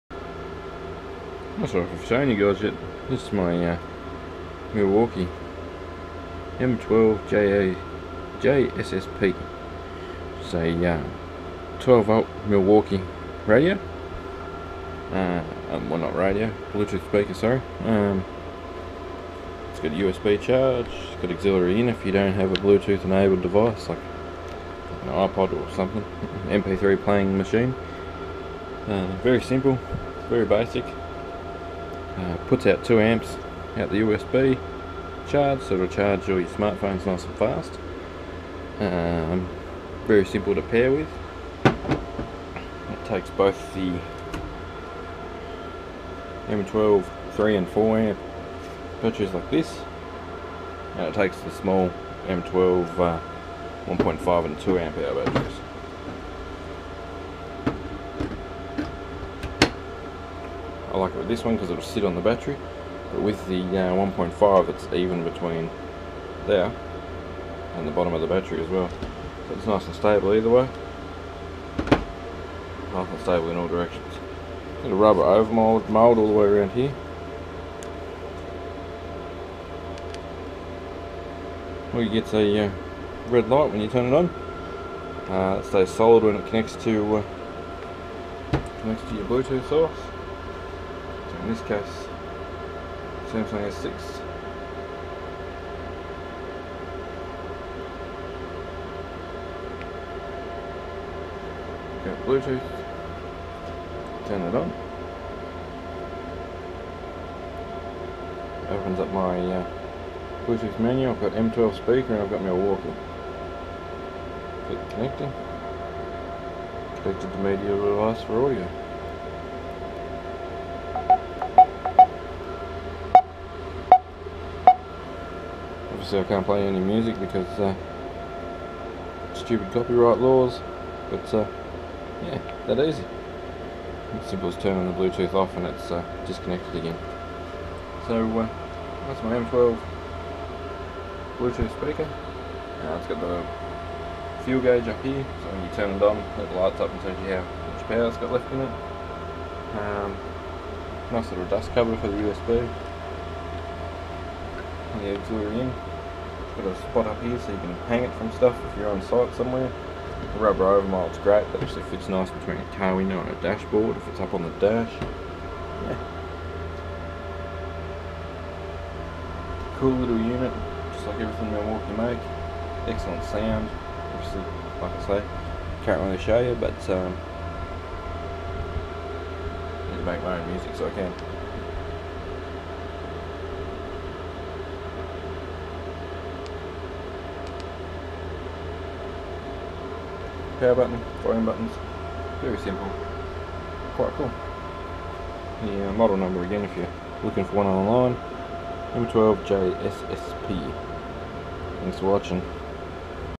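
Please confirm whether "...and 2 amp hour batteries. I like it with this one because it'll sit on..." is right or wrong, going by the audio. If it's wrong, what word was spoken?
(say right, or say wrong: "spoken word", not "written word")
right.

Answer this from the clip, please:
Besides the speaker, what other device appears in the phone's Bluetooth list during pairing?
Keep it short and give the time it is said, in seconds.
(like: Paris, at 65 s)
walkie, at 112 s.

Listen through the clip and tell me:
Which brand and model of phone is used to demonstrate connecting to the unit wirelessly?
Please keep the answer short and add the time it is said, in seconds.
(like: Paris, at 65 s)
Samsung S6, at 93 s.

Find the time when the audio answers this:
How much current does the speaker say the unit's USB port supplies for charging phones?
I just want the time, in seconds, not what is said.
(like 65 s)
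32 s.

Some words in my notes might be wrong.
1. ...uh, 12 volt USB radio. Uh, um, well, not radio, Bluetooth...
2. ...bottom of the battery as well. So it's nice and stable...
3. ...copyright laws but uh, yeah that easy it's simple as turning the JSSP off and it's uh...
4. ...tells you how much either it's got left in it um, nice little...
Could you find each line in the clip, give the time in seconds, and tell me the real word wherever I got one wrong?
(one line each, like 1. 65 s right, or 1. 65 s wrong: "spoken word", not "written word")
1. 10 s wrong: "Milwaukee", not "USB"
2. 67 s right
3. 129 s wrong: "Bluetooth", not "JSSP"
4. 147 s wrong: "power", not "either".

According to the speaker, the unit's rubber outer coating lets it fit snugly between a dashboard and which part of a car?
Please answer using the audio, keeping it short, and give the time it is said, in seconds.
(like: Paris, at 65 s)
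car window, at 162 s.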